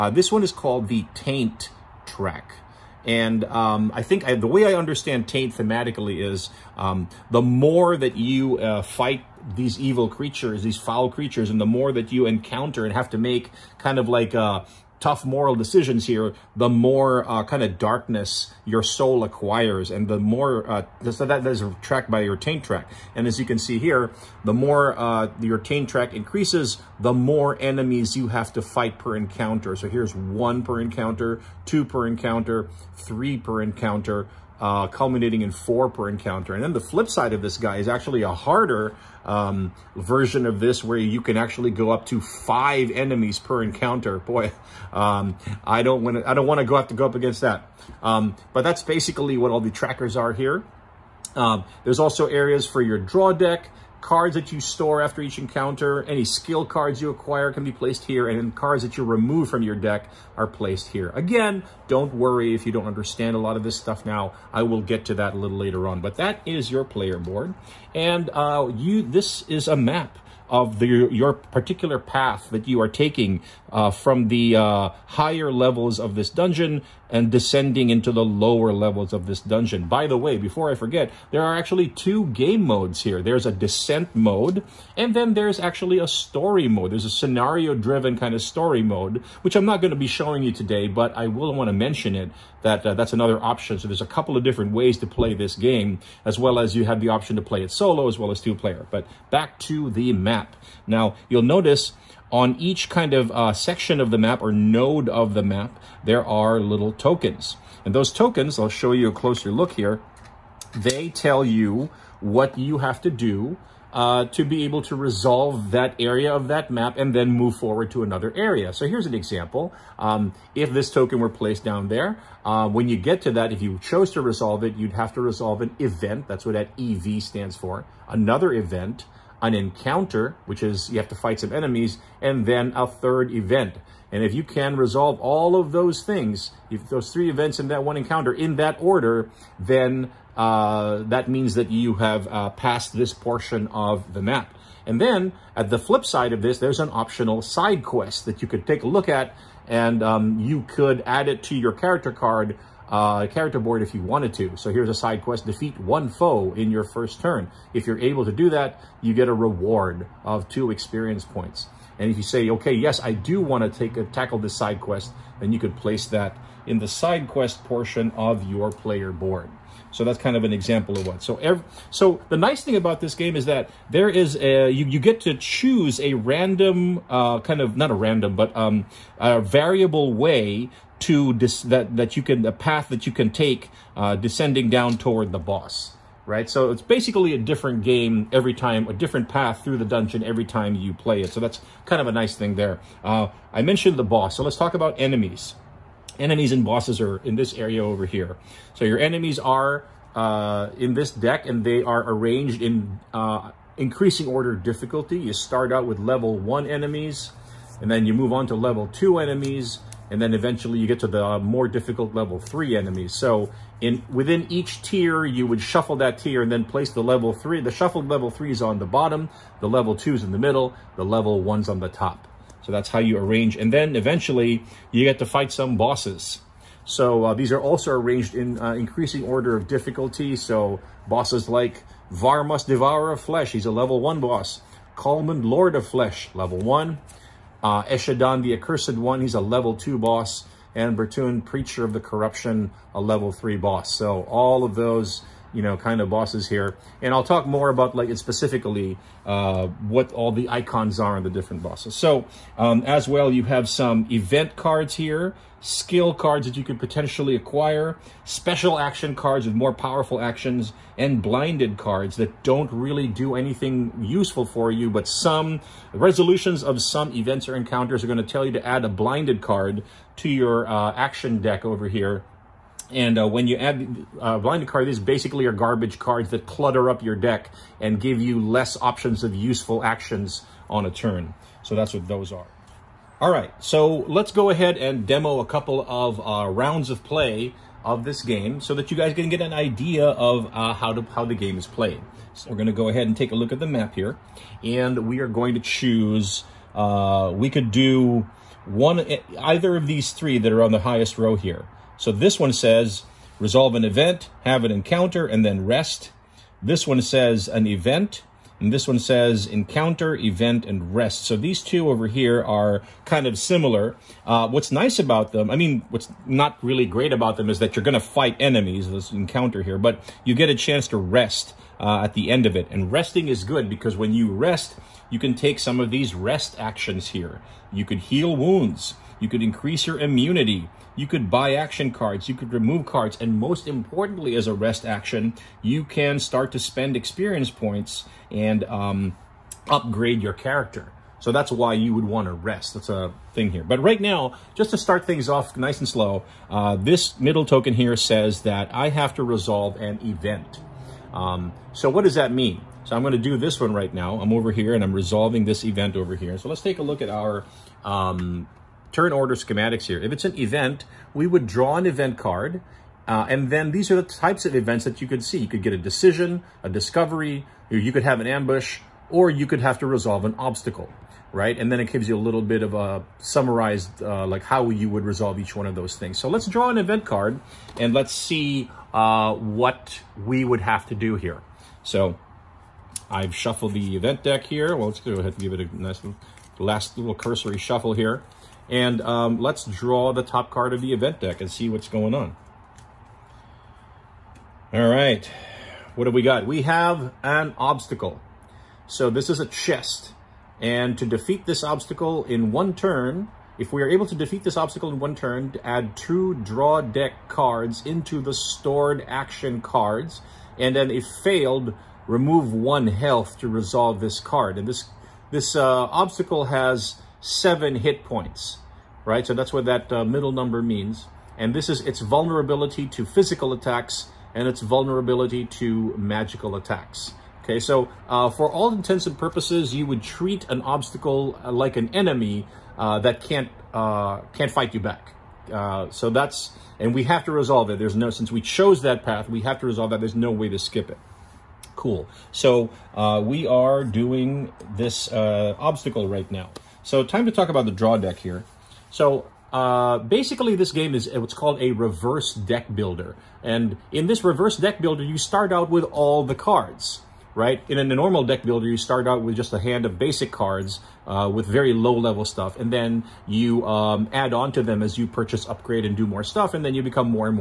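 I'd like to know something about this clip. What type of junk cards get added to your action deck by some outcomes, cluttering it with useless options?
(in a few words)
Blinded cards.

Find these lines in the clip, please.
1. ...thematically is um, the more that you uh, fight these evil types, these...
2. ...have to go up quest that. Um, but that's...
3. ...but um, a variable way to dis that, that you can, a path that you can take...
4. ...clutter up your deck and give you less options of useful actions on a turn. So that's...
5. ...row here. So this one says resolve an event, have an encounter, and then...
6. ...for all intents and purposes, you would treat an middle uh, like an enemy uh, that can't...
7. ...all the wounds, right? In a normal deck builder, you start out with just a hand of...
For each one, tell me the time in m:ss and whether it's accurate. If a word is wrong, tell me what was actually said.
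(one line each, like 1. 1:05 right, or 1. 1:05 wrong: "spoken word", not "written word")
1. 0:05 wrong: "creatures", not "types"
2. 0:46 wrong: "against", not "quest"
3. 2:58 right
4. 4:36 right
5. 5:01 right
6. 7:08 wrong: "obstacle", not "middle"
7. 7:35 wrong: "cards", not "wounds".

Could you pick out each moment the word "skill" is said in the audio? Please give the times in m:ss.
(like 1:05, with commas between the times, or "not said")
0:56, 4:15.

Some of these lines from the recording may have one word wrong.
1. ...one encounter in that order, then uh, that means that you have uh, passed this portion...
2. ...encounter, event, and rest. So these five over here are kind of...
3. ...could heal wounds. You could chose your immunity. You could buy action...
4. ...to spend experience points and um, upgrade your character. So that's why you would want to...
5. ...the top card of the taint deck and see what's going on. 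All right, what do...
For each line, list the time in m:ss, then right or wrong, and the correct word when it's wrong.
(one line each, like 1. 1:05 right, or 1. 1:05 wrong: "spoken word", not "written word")
1. 2:17 right
2. 5:09 wrong: "two", not "five"
3. 5:27 wrong: "increase", not "chose"
4. 5:36 right
5. 6:30 wrong: "event", not "taint".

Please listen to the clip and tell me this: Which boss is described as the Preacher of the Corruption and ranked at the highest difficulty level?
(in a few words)
Bertun.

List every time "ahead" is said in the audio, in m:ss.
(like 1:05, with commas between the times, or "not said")
4:44, 4:52, 6:25.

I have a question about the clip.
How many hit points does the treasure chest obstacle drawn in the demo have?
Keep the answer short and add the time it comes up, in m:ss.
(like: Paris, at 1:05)
7, at 6:57.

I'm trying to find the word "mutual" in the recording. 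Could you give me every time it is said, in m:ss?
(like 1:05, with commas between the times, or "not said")
not said.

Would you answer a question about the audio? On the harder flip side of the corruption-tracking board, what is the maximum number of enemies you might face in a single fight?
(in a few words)
5.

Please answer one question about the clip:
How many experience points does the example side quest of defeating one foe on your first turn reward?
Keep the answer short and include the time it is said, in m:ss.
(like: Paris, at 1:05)
2, at 2:40.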